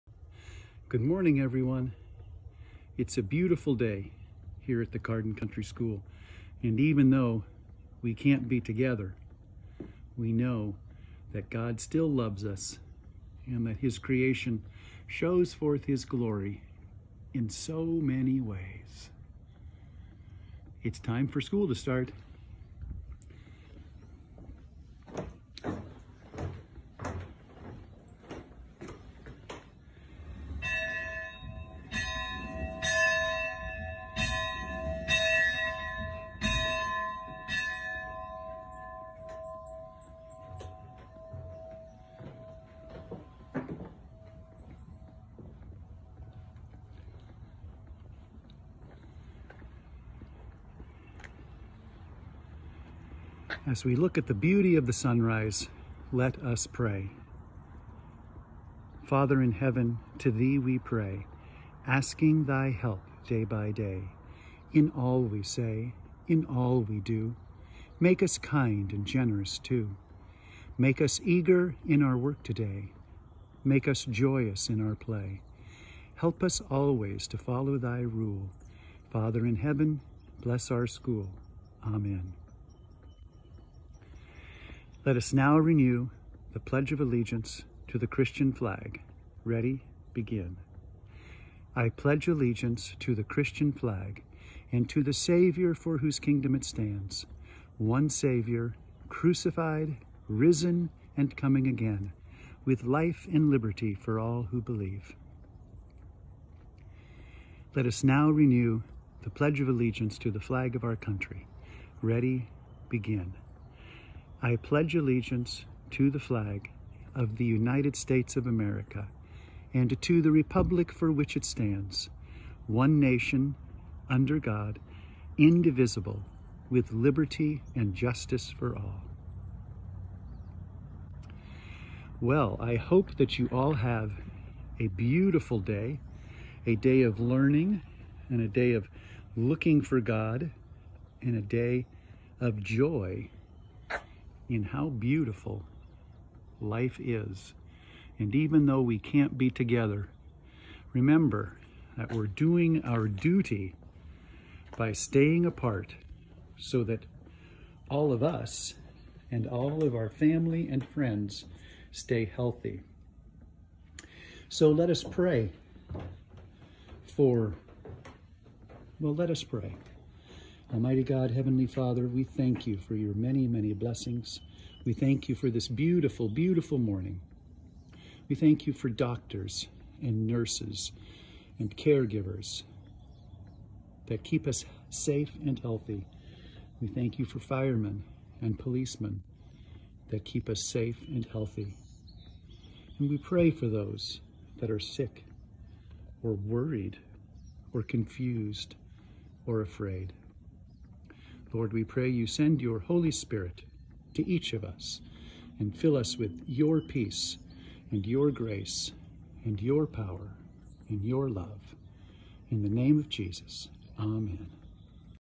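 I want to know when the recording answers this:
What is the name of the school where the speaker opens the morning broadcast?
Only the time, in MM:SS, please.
00:04.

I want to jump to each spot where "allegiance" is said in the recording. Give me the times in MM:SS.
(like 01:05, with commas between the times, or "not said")
01:27, 01:32, 01:49, 01:54.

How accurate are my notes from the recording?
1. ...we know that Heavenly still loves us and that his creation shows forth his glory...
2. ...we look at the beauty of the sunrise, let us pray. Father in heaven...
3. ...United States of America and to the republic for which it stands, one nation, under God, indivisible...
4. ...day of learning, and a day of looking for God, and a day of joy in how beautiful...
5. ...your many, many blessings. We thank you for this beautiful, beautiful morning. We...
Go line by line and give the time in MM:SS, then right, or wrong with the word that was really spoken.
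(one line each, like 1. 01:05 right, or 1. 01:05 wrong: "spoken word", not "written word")
1. 00:10 wrong: "God", not "Heavenly"
2. 00:53 right
3. 01:57 right
4. 02:16 right
5. 02:52 right.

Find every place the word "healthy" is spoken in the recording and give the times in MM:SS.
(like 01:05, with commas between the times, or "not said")
02:42, 03:05, 03:11.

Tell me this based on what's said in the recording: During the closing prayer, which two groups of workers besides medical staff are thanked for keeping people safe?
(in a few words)
Firemen and policemen.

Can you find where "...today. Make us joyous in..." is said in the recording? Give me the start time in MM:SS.
01:12.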